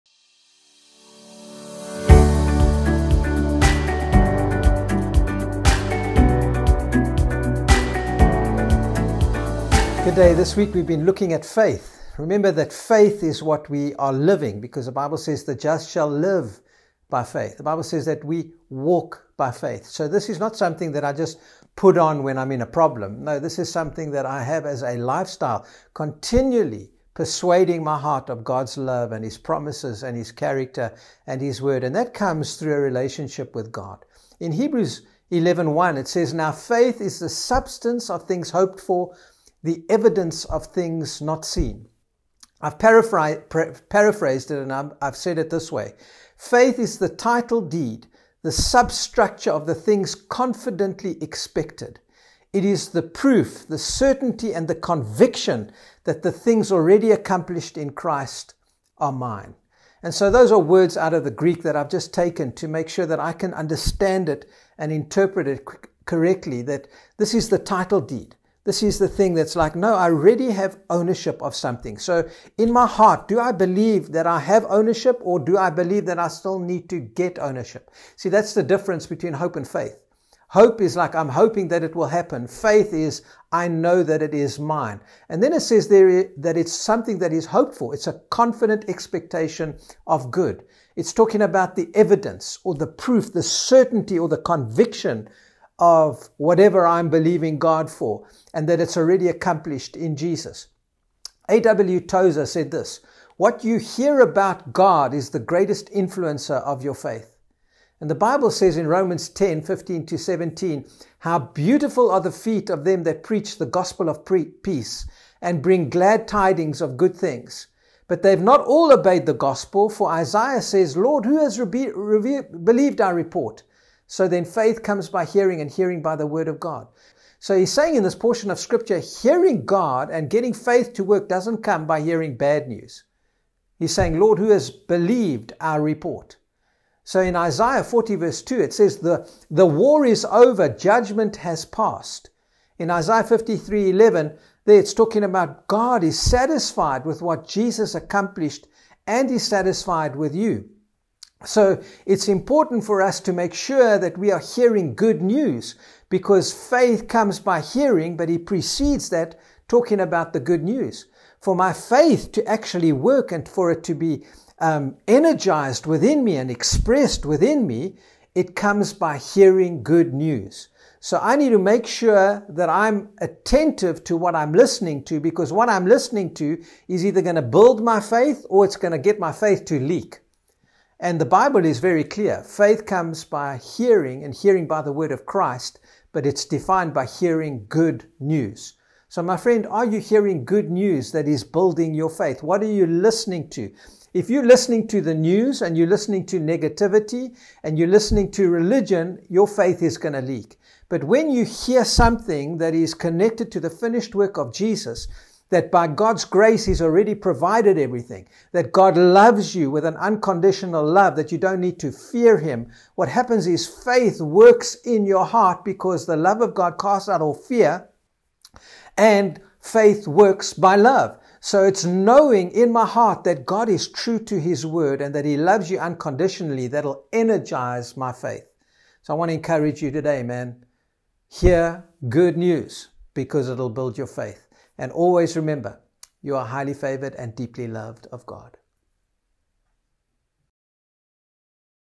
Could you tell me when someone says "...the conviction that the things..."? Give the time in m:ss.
0:54.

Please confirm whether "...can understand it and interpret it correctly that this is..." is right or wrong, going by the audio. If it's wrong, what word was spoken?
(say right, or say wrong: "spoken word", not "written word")
right.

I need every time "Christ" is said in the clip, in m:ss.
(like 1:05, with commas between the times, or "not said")
0:57, 3:05.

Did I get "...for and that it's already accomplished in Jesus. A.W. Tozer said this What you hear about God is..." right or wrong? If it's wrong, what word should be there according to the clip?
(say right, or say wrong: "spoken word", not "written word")
right.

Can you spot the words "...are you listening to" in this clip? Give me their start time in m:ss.
3:12.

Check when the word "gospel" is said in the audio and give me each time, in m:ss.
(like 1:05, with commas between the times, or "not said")
1:53, 1:59.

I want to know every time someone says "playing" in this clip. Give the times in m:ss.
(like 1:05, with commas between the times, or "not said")
not said.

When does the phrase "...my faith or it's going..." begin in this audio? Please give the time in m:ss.
2:57.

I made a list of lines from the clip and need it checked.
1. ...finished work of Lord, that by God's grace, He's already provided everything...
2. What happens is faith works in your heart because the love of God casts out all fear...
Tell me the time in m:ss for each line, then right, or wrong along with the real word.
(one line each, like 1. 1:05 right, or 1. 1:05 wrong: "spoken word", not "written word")
1. 3:23 wrong: "Jesus", not "Lord"
2. 3:32 right.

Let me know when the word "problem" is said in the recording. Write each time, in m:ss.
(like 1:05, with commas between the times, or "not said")
0:22.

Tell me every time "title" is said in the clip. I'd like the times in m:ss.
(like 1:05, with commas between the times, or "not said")
0:47, 1:07.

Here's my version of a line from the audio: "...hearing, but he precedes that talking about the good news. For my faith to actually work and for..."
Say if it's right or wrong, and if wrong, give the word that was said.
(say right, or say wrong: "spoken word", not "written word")
right.